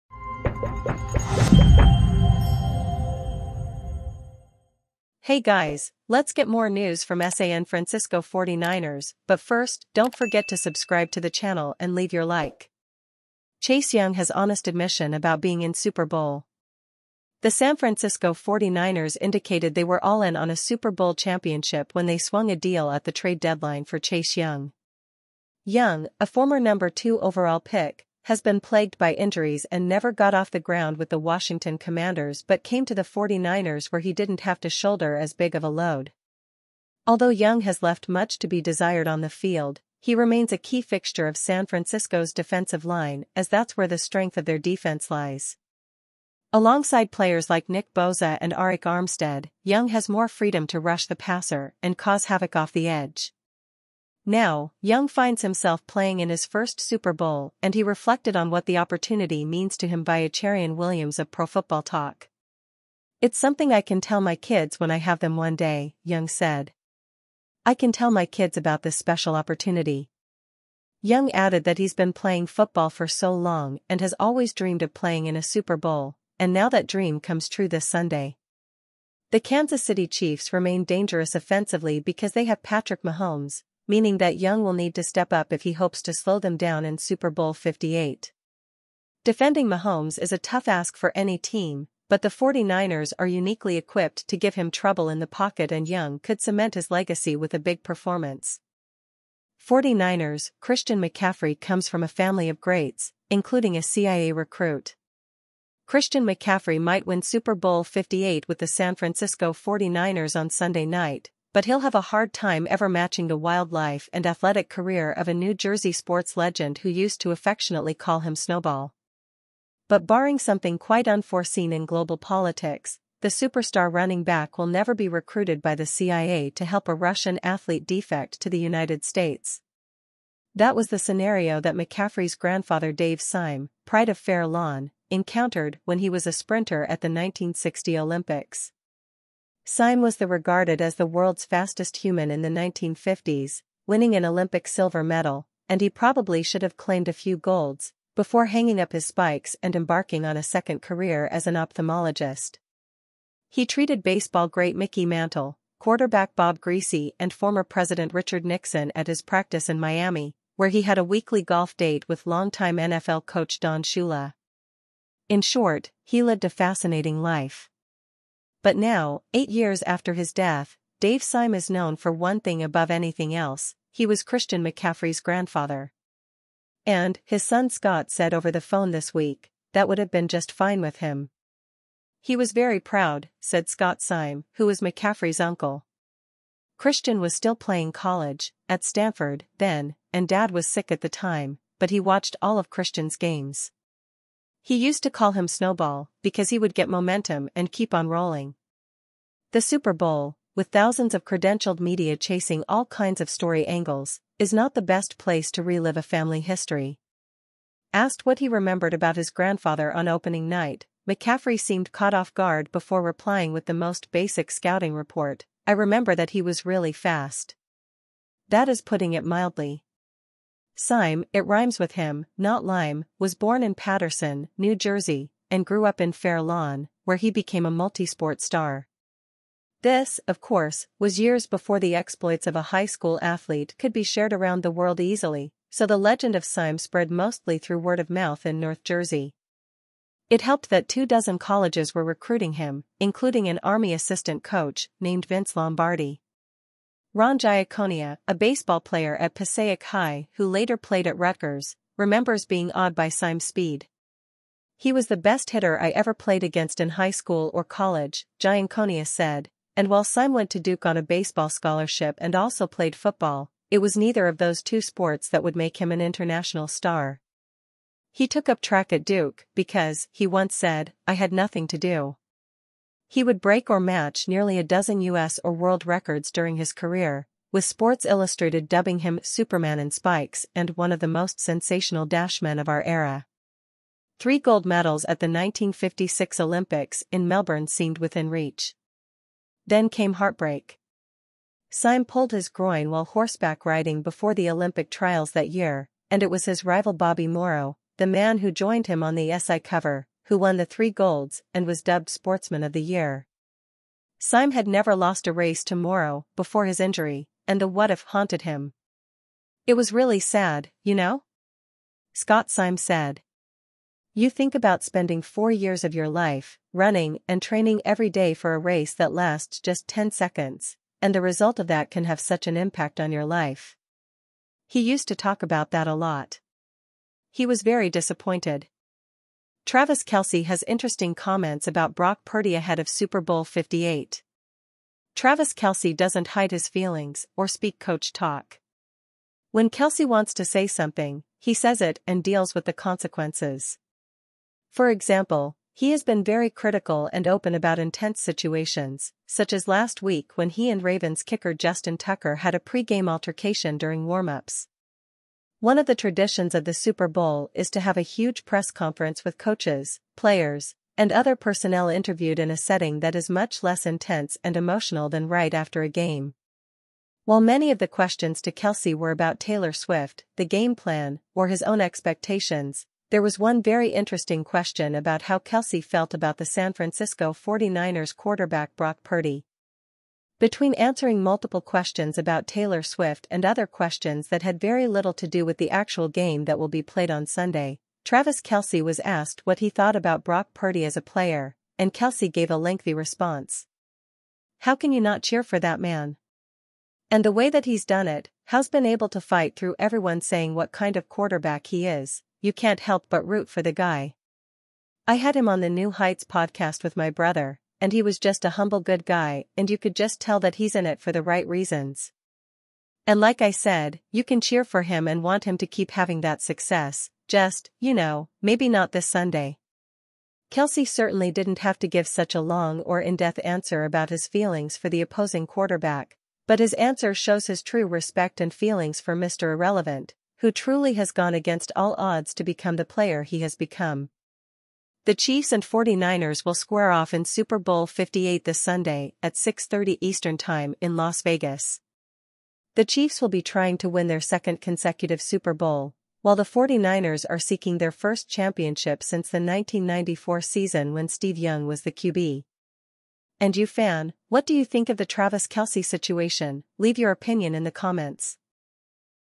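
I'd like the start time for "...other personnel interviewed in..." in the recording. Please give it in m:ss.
6:01.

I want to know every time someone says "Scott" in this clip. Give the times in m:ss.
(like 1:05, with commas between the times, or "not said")
2:57, 3:03, 5:12.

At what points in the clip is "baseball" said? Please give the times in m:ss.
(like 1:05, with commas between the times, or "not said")
2:34, 4:08, 4:21.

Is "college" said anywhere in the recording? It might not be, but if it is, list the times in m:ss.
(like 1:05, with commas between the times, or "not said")
3:07, 4:01, 4:17.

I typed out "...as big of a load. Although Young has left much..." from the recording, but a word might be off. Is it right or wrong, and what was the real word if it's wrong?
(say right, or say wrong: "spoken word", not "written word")
right.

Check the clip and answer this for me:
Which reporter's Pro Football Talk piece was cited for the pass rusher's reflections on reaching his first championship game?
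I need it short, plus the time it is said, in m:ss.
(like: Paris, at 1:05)
Acharian Williams, at 1:00.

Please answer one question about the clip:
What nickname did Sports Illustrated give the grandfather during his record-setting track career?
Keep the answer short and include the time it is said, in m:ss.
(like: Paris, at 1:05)
Superman in spikes, at 4:39.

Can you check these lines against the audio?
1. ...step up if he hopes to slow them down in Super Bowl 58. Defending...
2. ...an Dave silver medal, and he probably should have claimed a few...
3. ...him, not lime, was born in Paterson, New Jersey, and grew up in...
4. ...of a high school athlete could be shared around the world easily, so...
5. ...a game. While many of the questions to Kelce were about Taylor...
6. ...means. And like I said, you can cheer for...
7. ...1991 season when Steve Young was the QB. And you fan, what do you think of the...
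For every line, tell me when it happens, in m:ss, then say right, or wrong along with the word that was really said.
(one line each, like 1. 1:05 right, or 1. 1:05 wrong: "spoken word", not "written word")
1. 1:25 right
2. 2:24 wrong: "Olympic", not "Dave"
3. 3:41 right
4. 3:52 right
5. 6:05 right
6. 6:51 wrong: "reasons", not "means"
7. 7:29 wrong: "1994", not "1991".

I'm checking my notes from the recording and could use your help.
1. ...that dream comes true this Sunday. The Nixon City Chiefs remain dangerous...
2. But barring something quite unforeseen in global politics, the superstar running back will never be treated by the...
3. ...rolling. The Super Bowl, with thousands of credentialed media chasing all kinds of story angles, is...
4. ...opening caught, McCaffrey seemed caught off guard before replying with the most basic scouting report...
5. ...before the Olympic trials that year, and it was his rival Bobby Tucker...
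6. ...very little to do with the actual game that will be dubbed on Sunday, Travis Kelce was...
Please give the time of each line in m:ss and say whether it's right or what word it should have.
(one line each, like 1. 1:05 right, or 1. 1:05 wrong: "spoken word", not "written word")
1. 1:16 wrong: "Kansas", not "Nixon"
2. 1:59 wrong: "recruited", not "treated"
3. 3:18 right
4. 3:30 wrong: "night", not "caught"
5. 4:54 wrong: "Morrow", not "Tucker"
6. 6:24 wrong: "played", not "dubbed".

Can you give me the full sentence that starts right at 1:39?
49ers Christian McCaffrey comes from a family of greats, including a CIA recruit.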